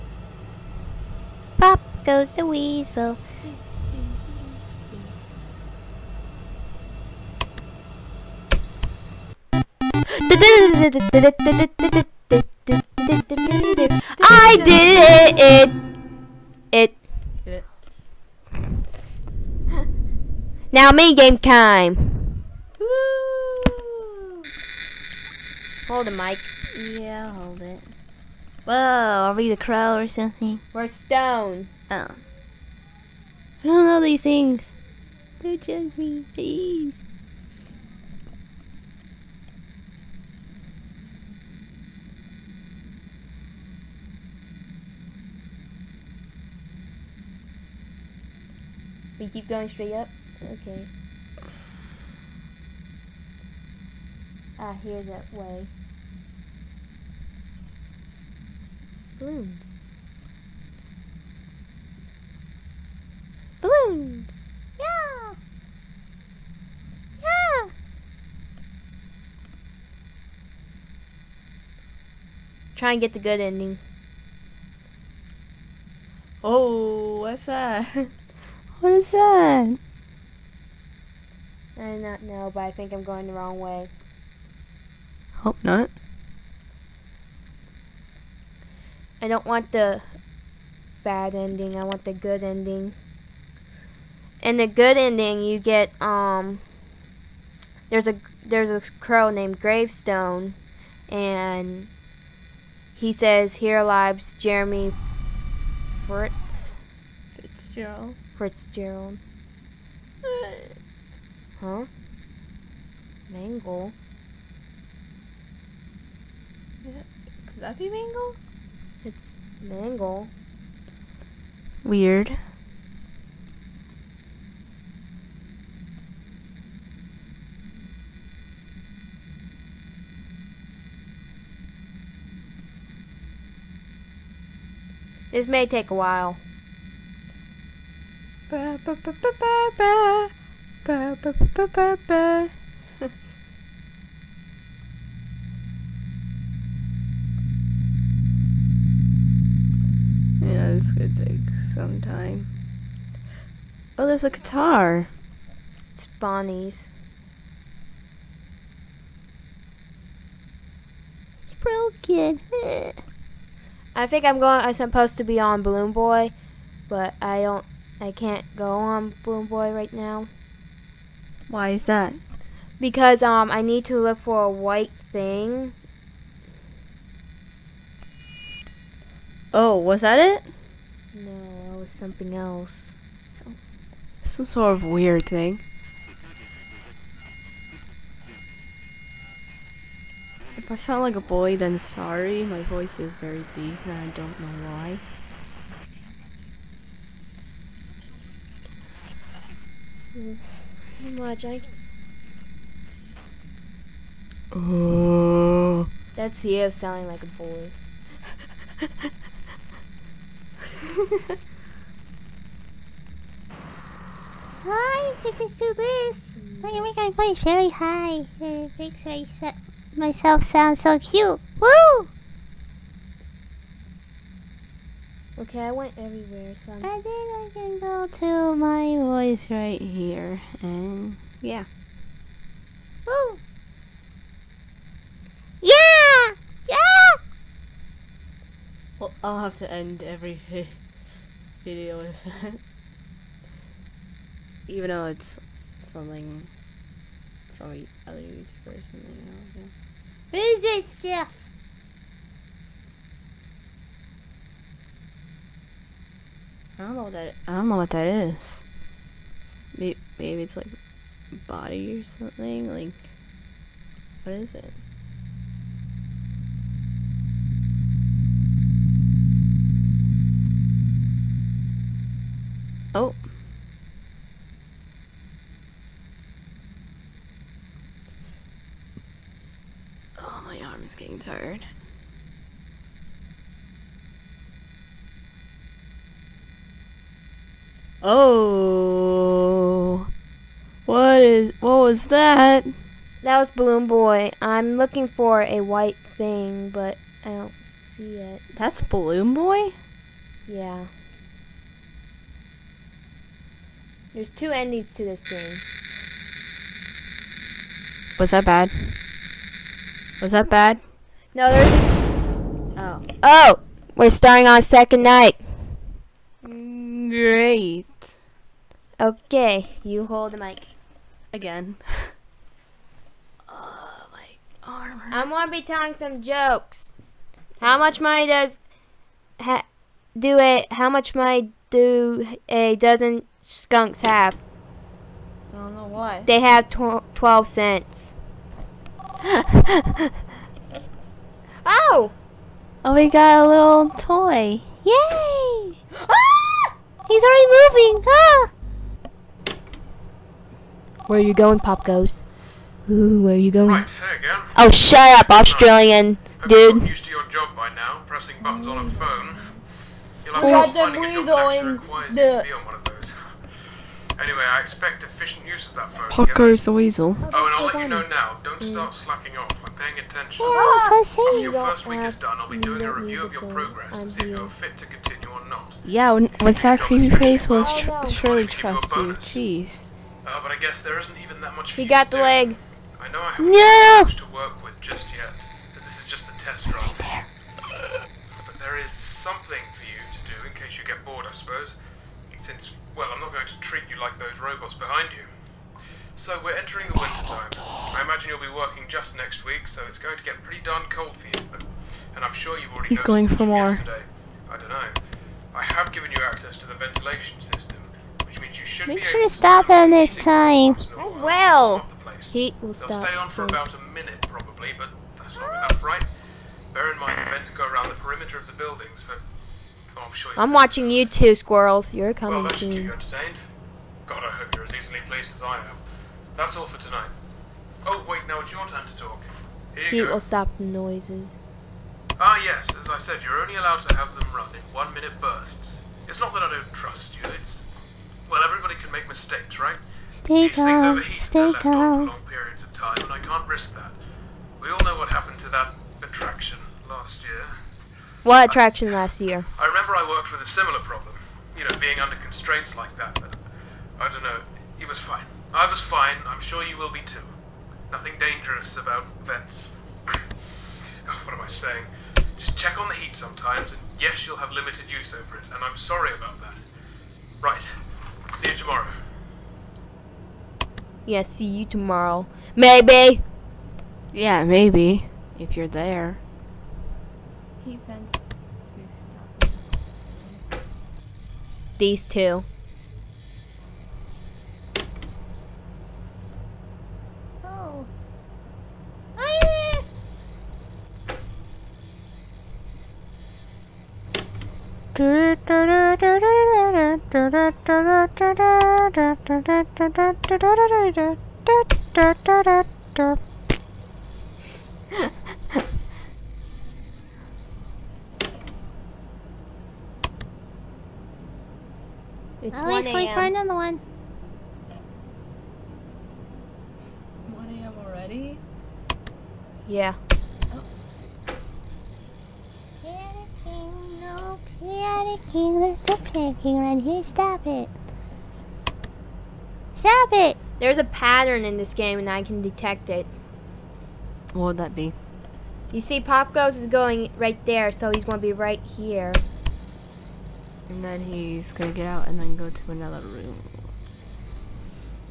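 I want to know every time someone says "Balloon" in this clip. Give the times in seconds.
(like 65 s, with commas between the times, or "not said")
59 s, 63 s, 165 s, 293 s, 298 s.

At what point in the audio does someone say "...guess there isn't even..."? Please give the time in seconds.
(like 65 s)
380 s.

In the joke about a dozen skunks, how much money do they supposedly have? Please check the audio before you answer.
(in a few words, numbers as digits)
12 cents.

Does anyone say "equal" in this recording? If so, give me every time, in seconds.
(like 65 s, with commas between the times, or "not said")
not said.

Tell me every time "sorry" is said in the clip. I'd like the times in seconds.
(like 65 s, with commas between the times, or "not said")
191 s, 465 s.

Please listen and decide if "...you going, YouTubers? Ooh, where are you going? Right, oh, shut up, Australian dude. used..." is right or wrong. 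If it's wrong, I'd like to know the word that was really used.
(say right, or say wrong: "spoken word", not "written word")
wrong: "Popgoes", not "YouTubers".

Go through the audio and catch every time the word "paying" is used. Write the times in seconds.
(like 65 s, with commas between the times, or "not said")
369 s.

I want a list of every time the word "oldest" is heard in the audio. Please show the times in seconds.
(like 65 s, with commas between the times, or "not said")
not said.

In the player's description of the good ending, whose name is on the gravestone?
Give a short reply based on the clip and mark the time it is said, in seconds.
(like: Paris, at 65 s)
Jeremy Fritz Fitzgerald, at 104 s.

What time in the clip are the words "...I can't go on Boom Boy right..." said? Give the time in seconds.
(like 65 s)
168 s.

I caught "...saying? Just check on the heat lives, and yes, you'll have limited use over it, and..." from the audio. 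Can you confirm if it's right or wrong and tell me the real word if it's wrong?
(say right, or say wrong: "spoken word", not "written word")
wrong: "sometimes", not "lives".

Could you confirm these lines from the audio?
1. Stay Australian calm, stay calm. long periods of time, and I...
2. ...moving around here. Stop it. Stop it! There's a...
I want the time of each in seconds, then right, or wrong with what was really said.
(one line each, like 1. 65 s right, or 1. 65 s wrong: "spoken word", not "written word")
1. 440 s wrong: "These", not "Australian"
2. 526 s wrong: "panicking", not "moving".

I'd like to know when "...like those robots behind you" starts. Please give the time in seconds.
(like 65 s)
394 s.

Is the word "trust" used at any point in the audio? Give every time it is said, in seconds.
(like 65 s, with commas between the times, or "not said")
378 s, 436 s.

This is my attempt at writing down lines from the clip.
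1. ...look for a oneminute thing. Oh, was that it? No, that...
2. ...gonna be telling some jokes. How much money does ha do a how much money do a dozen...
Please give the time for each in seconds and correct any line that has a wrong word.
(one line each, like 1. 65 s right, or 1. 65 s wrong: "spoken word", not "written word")
1. 173 s wrong: "white", not "oneminute"
2. 325 s right.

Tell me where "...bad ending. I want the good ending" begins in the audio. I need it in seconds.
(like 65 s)
91 s.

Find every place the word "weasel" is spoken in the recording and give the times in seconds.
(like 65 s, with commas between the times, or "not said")
2 s, 366 s.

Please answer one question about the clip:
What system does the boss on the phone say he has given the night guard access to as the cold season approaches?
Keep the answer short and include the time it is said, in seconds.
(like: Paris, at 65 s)
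Ventilation system, at 406 s.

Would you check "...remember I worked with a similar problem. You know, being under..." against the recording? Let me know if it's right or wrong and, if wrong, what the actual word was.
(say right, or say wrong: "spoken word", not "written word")
right.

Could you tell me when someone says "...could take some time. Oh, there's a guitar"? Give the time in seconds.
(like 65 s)
150 s.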